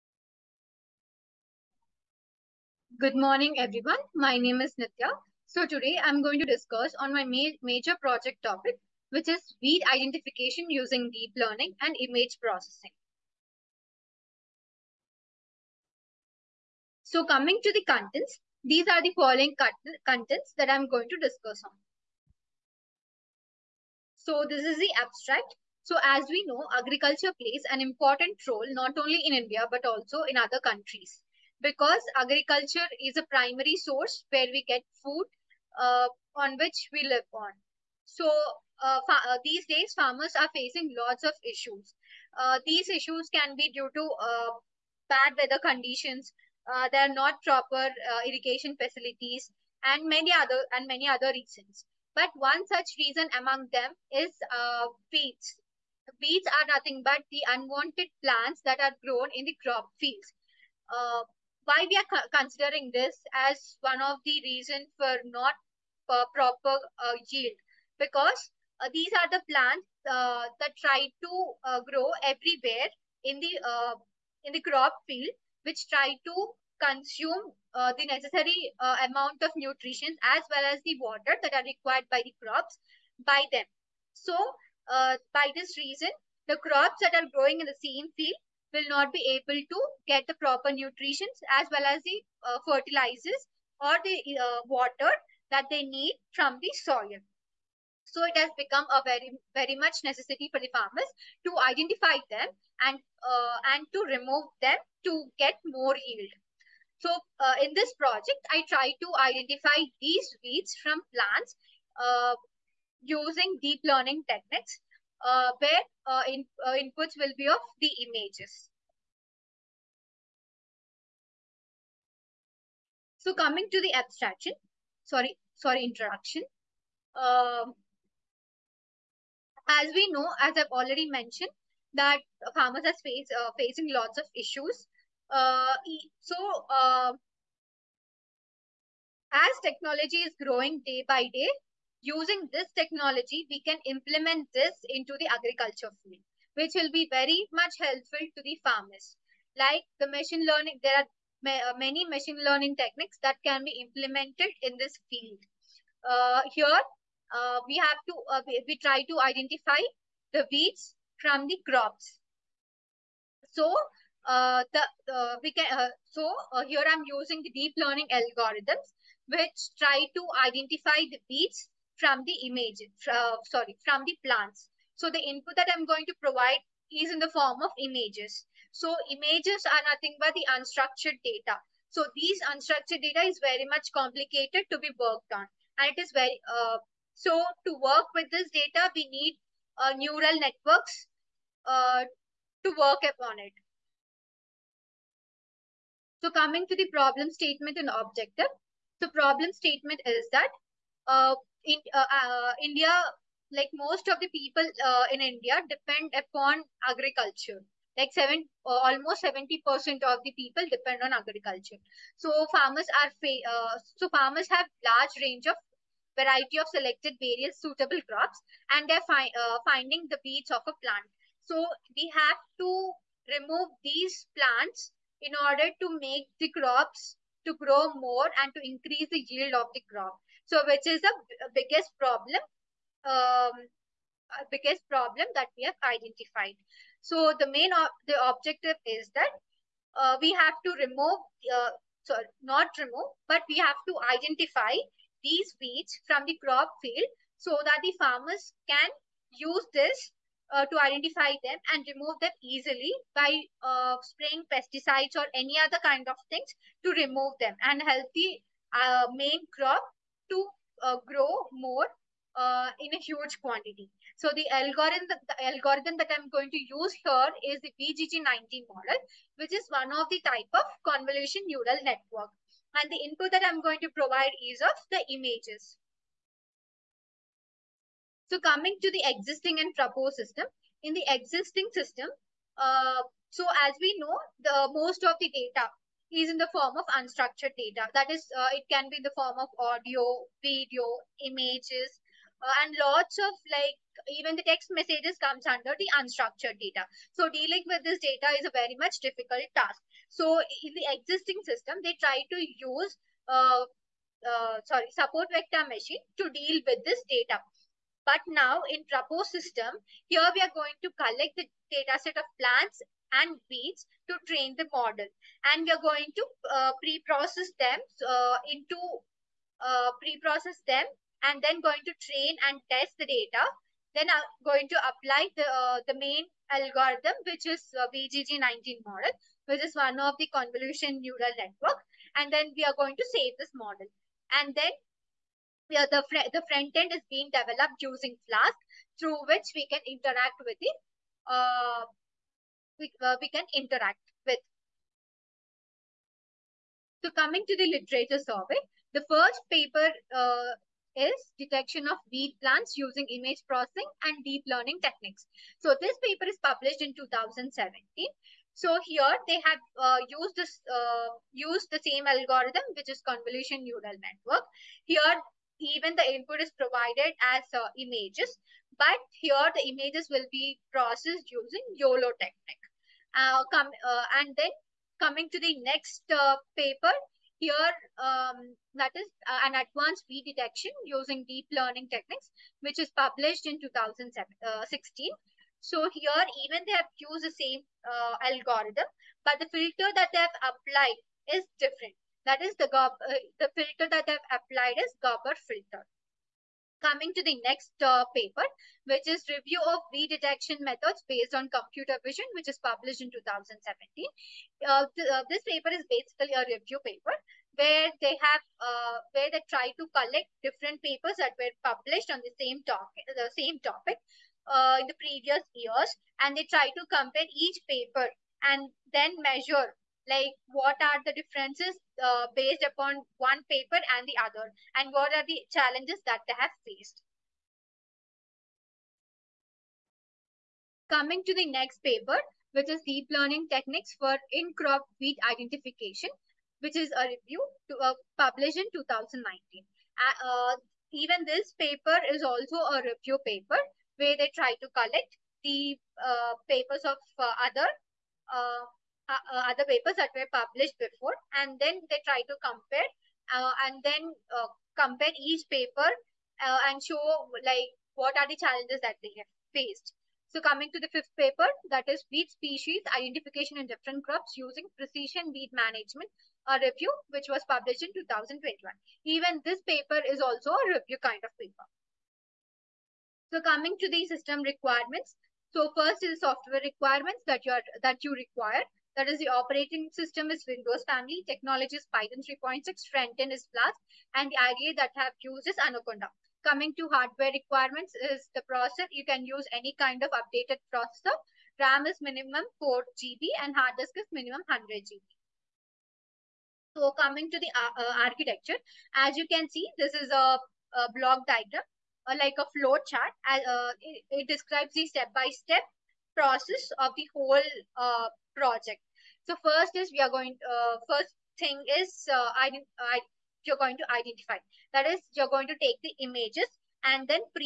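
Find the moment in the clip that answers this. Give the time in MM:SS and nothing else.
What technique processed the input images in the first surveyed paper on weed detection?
06:11.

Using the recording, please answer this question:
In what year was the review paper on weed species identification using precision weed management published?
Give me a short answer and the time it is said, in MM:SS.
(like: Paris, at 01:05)
2021, at 07:47.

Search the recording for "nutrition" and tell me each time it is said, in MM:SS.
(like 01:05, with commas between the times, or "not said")
01:19, 01:30.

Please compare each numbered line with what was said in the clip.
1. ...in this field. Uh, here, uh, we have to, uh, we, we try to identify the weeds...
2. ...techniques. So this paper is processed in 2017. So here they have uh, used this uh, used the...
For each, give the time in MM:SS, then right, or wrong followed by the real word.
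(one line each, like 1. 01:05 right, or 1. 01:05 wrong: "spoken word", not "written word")
1. 02:34 right
2. 05:54 wrong: "published", not "processed".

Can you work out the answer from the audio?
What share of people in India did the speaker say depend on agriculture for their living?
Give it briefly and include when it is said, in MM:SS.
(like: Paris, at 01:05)
70 percent, at 03:29.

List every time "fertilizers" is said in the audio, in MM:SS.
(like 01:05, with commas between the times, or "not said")
01:32.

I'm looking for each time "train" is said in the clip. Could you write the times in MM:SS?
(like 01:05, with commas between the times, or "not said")
05:14, 05:22.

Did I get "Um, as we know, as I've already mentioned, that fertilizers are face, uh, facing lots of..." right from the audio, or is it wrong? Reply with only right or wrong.
wrong.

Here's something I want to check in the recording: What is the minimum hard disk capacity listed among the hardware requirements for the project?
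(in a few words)
100 GB.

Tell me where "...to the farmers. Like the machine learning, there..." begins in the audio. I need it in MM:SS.
02:28.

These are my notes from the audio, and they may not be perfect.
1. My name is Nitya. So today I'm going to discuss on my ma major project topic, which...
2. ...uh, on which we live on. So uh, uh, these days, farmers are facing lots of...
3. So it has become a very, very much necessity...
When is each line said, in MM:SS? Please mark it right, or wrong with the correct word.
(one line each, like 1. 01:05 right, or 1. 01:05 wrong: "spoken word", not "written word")
1. 00:04 right
2. 00:35 right
3. 01:38 right.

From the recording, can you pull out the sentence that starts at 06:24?
Uh, so here, even they have used the same uh, algorithm, but the filter that they have applied is different.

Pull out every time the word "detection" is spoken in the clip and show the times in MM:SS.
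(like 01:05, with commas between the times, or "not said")
05:51, 06:20, 06:40.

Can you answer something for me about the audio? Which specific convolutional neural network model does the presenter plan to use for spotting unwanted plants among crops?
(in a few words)
VGG19.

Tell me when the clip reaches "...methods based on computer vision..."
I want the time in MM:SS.
06:40.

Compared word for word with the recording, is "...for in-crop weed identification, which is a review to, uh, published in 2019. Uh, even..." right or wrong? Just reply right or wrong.
right.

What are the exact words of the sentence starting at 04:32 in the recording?
And the input that I'm going to provide is of the images.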